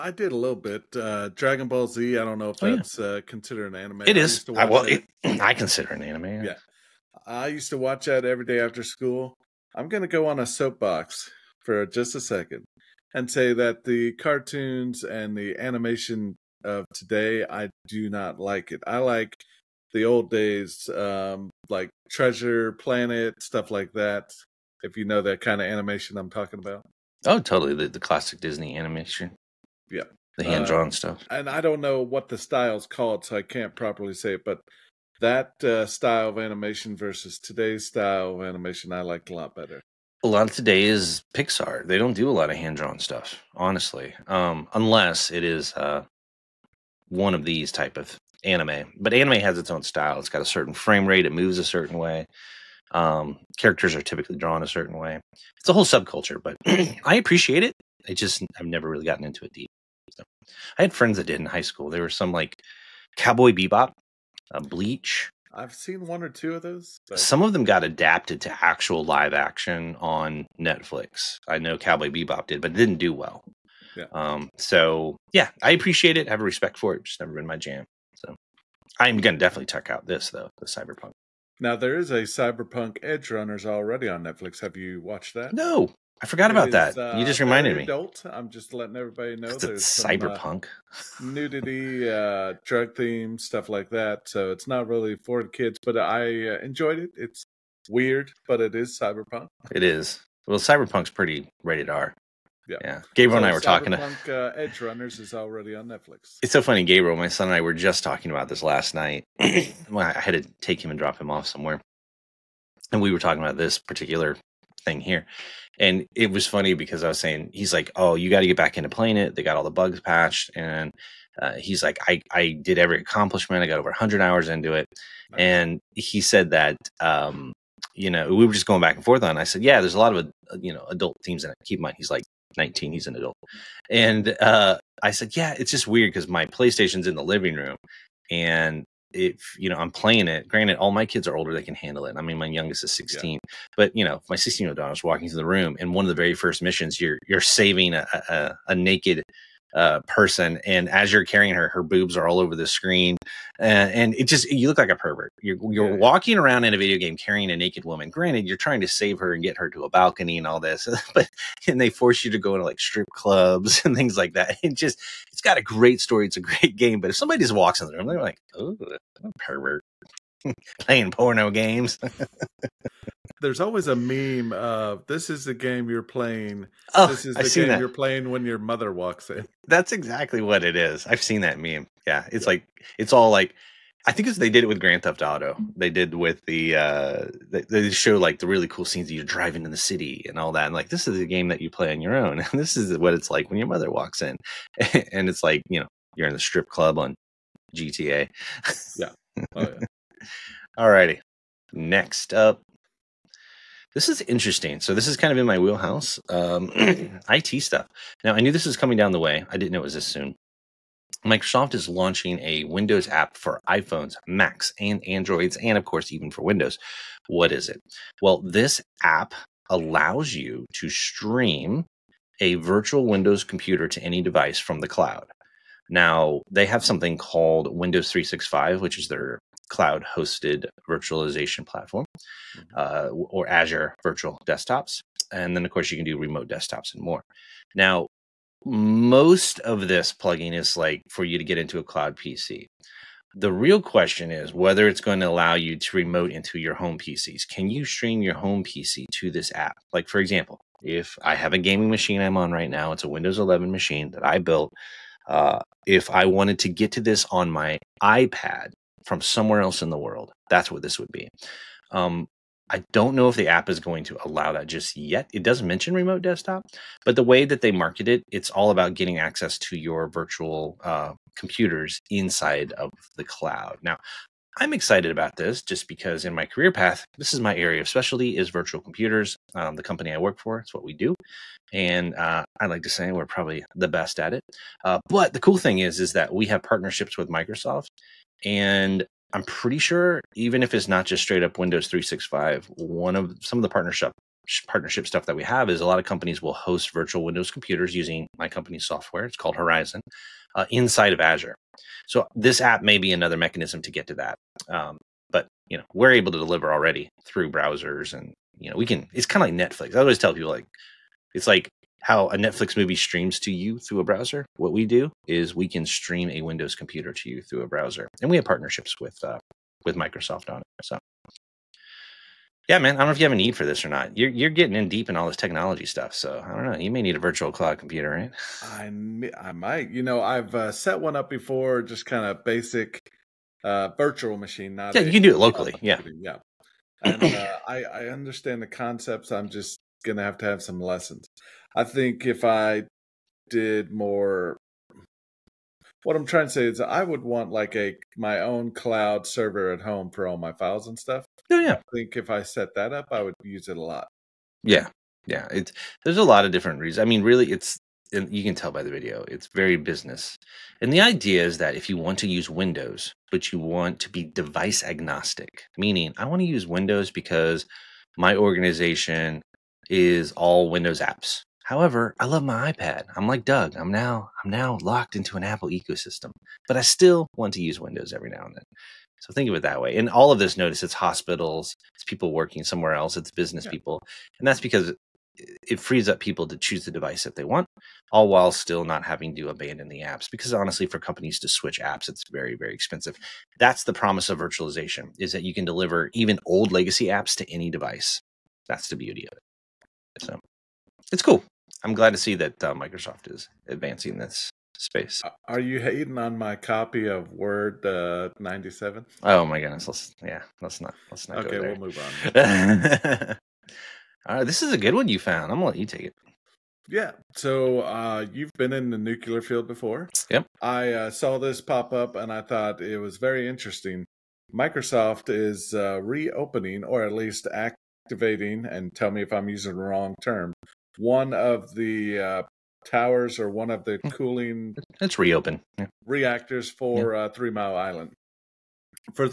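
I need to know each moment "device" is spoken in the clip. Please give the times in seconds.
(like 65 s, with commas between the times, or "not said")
224 s, 364 s, 386 s, 397 s.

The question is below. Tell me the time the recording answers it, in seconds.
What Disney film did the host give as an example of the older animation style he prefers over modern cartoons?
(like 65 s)
22 s.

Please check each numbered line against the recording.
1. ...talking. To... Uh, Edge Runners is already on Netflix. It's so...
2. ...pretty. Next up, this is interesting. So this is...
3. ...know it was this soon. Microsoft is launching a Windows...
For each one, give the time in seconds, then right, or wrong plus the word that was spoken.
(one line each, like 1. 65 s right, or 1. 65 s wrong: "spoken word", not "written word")
1. 103 s right
2. 200 s wrong: "righty", not "pretty"
3. 209 s right.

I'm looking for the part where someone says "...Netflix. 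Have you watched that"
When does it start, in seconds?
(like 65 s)
84 s.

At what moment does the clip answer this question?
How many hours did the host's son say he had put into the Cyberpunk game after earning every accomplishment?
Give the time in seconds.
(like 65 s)
123 s.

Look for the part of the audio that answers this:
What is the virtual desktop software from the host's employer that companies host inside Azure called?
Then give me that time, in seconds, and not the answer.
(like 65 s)
299 s.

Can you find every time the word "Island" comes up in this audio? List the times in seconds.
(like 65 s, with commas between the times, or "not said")
437 s.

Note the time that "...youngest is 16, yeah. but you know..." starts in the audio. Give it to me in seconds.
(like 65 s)
142 s.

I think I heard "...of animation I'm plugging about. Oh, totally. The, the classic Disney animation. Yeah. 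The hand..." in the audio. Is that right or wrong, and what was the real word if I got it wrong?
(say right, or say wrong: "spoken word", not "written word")
wrong: "talking", not "plugging".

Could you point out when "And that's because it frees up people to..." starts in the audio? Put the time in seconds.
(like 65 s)
384 s.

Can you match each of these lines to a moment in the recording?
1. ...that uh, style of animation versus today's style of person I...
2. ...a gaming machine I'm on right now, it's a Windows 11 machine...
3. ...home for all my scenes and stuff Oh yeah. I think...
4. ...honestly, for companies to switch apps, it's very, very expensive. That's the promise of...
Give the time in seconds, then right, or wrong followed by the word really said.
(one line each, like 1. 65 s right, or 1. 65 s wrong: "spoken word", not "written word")
1. 35 s wrong: "animation", not "person"
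2. 251 s right
3. 349 s wrong: "files", not "scenes"
4. 390 s right.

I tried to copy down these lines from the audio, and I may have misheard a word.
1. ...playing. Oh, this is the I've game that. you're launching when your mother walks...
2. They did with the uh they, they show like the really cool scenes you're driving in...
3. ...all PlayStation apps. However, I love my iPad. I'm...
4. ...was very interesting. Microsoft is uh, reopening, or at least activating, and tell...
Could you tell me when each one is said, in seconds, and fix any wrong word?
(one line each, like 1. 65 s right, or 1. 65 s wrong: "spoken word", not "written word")
1. 176 s wrong: "playing", not "launching"
2. 185 s right
3. 370 s wrong: "Windows", not "PlayStation"
4. 422 s right.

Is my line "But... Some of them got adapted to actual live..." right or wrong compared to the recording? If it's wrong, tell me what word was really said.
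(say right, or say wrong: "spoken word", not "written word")
right.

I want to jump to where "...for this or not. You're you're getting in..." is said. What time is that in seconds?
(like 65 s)
323 s.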